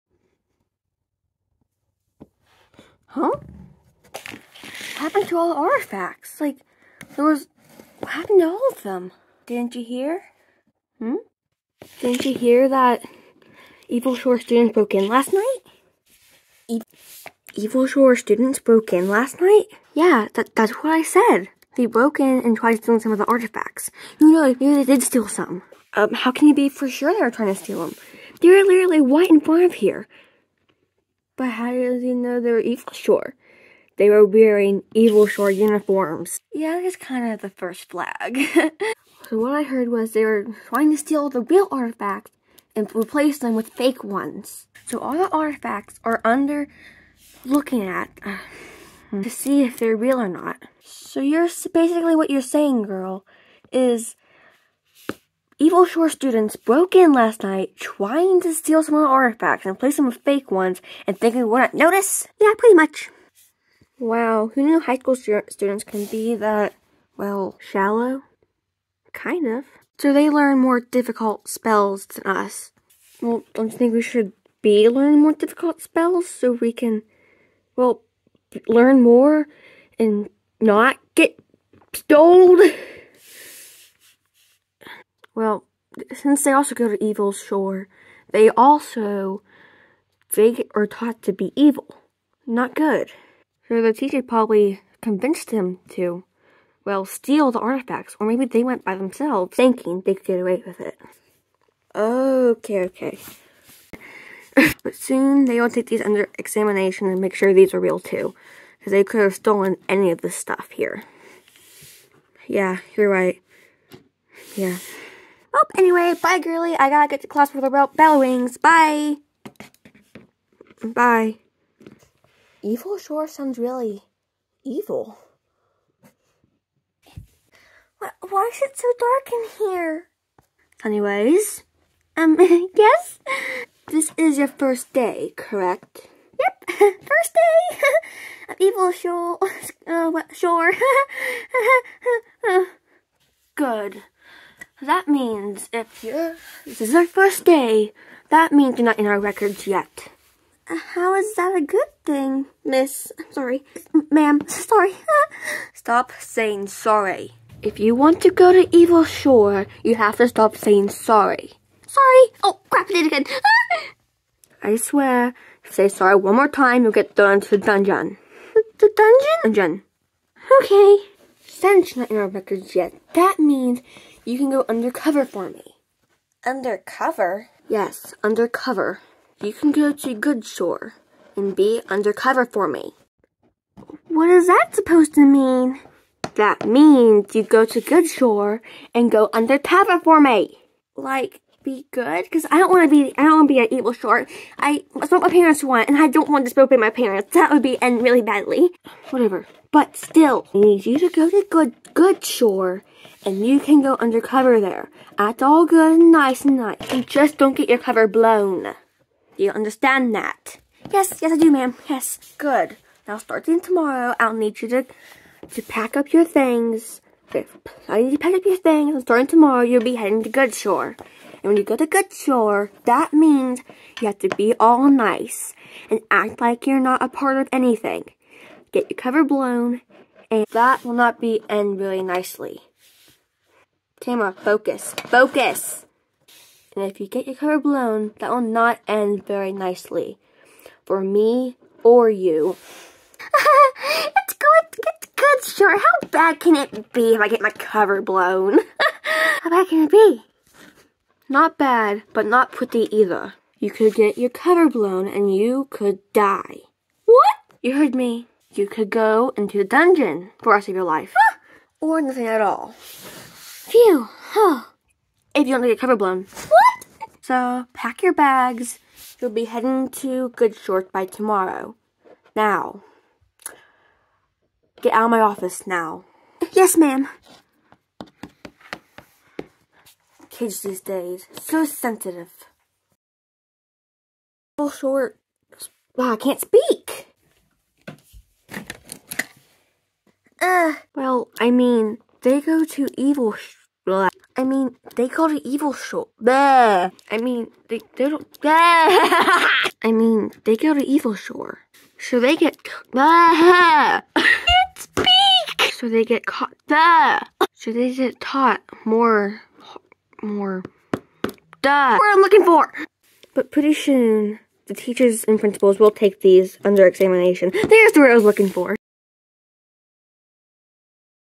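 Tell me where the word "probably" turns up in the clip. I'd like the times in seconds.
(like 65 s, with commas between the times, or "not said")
94 s.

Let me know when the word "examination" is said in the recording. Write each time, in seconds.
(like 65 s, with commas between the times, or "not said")
106 s, 316 s.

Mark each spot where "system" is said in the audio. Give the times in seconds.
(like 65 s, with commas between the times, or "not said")
not said.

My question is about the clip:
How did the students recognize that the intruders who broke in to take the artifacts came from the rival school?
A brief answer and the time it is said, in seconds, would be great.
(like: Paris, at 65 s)
Evil Shore uniforms, at 34 s.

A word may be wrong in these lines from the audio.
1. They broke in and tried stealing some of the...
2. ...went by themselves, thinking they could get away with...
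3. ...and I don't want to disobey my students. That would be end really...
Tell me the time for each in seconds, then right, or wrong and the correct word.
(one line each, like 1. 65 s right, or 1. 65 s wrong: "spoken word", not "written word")
1. 21 s right
2. 98 s right
3. 195 s wrong: "parents", not "students".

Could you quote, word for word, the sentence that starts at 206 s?
You just don't get your cover blown.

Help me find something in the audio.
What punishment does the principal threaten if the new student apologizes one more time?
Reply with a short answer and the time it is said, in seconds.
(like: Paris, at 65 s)
thrown into the dungeon, at 167 s.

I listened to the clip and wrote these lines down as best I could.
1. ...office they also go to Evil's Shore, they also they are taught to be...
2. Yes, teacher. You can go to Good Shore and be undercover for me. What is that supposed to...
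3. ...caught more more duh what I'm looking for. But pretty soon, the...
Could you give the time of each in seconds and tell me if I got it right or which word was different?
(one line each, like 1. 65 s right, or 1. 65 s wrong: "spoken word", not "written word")
1. 86 s wrong: "since", not "office"
2. 177 s wrong: "undercover", not "teacher"
3. 308 s wrong: "taught", not "caught".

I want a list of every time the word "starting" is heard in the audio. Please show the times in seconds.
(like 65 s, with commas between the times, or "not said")
213 s, 219 s.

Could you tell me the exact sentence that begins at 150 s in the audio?
Uh, how is that a good thing, miss?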